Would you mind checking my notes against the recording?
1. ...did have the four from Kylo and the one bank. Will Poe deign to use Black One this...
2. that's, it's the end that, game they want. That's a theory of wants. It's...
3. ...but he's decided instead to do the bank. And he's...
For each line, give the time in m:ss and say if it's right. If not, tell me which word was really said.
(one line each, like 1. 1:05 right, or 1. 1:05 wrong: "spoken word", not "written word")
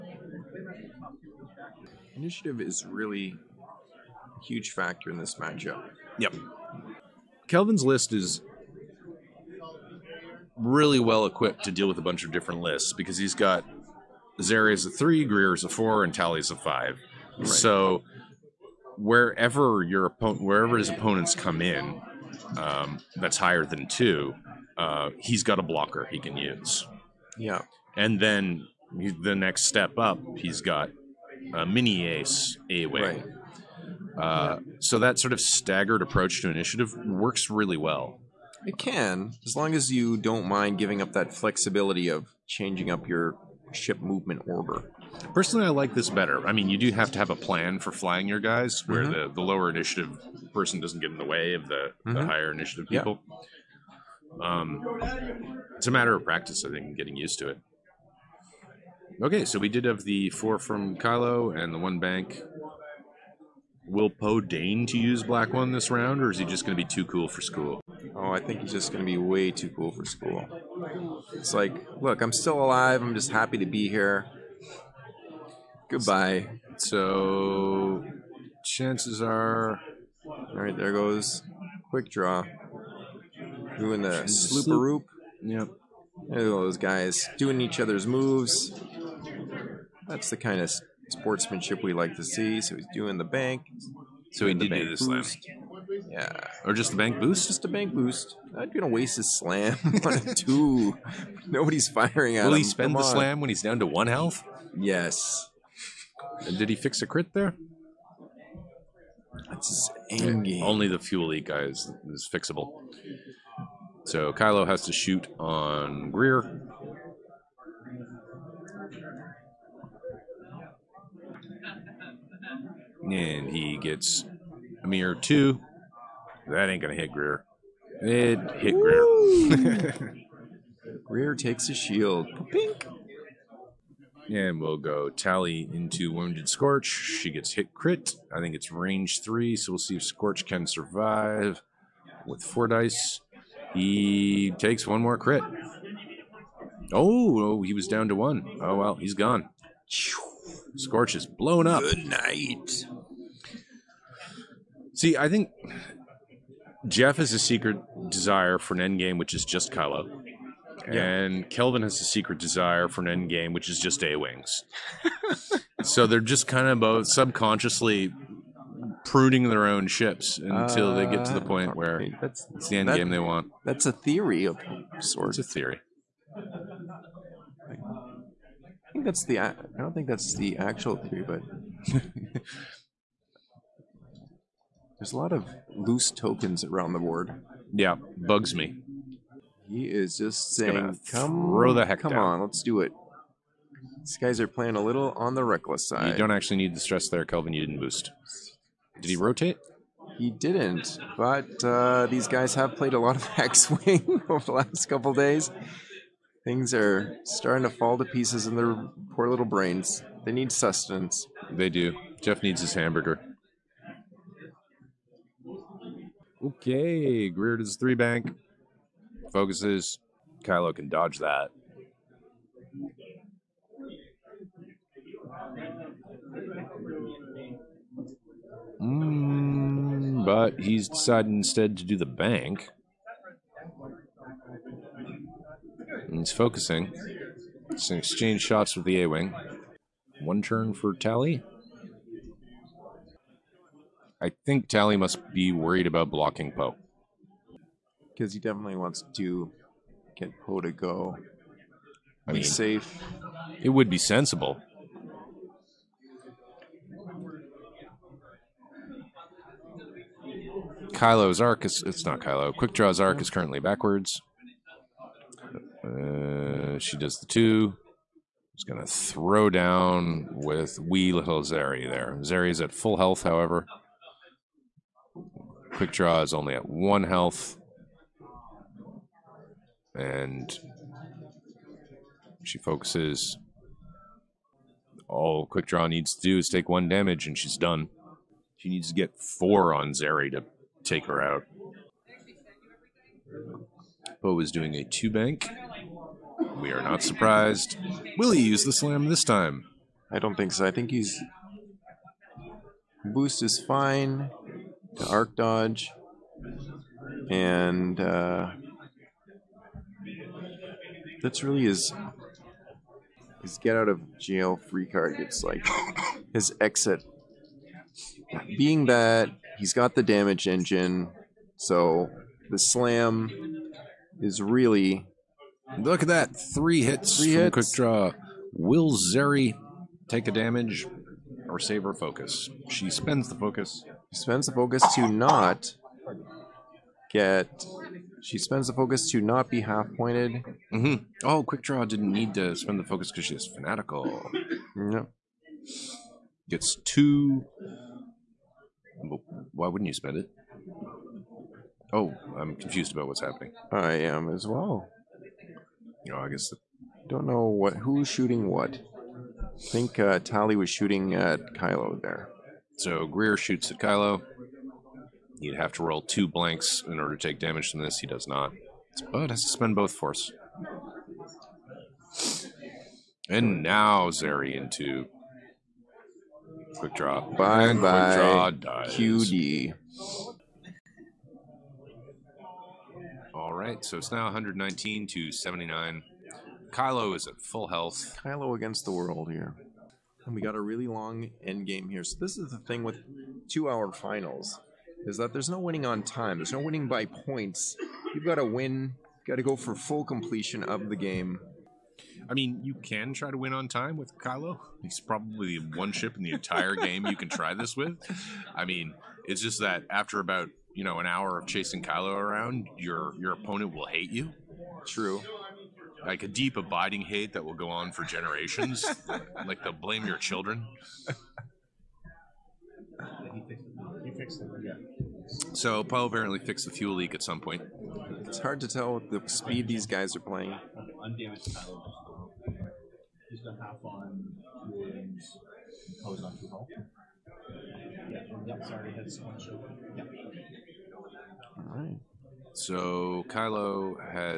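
1. 0:59 right
2. 2:52 wrong: "sorts", not "wants"
3. 3:50 right.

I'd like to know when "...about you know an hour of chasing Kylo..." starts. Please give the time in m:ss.
6:50.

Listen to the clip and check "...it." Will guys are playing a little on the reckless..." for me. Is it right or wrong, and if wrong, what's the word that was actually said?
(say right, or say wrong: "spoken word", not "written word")
wrong: "These", not "Will".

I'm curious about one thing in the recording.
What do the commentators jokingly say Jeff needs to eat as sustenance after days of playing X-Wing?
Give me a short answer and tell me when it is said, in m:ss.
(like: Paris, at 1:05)
Hamburger, at 3:32.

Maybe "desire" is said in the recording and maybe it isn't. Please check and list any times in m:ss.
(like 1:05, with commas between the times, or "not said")
2:38, 2:42.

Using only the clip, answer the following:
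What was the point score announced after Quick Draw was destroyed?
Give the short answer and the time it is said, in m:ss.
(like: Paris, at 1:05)
119 to 79, at 6:24.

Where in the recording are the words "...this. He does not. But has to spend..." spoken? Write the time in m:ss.
6:07.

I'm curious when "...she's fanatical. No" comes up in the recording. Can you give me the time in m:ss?
5:43.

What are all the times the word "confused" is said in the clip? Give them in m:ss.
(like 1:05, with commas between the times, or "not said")
5:52.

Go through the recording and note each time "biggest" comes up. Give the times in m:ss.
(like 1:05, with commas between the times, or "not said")
not said.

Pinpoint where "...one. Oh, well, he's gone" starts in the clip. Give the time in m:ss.
2:28.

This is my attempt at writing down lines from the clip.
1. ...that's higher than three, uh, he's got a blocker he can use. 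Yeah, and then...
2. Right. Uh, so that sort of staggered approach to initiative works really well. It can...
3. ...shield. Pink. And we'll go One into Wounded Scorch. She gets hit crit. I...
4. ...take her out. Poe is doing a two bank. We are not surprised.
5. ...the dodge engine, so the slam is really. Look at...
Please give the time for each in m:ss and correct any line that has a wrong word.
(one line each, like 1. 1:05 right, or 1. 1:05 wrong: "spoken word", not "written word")
1. 0:23 wrong: "two", not "three"
2. 0:33 right
3. 2:11 wrong: "Tally", not "One"
4. 4:50 right
5. 5:19 wrong: "damage", not "dodge".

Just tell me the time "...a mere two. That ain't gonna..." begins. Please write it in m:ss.
2:04.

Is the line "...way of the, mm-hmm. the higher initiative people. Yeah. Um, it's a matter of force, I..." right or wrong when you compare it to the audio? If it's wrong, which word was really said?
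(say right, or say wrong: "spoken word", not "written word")
wrong: "practice", not "force".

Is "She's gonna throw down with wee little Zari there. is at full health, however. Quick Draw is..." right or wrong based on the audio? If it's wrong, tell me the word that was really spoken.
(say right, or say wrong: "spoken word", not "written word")
right.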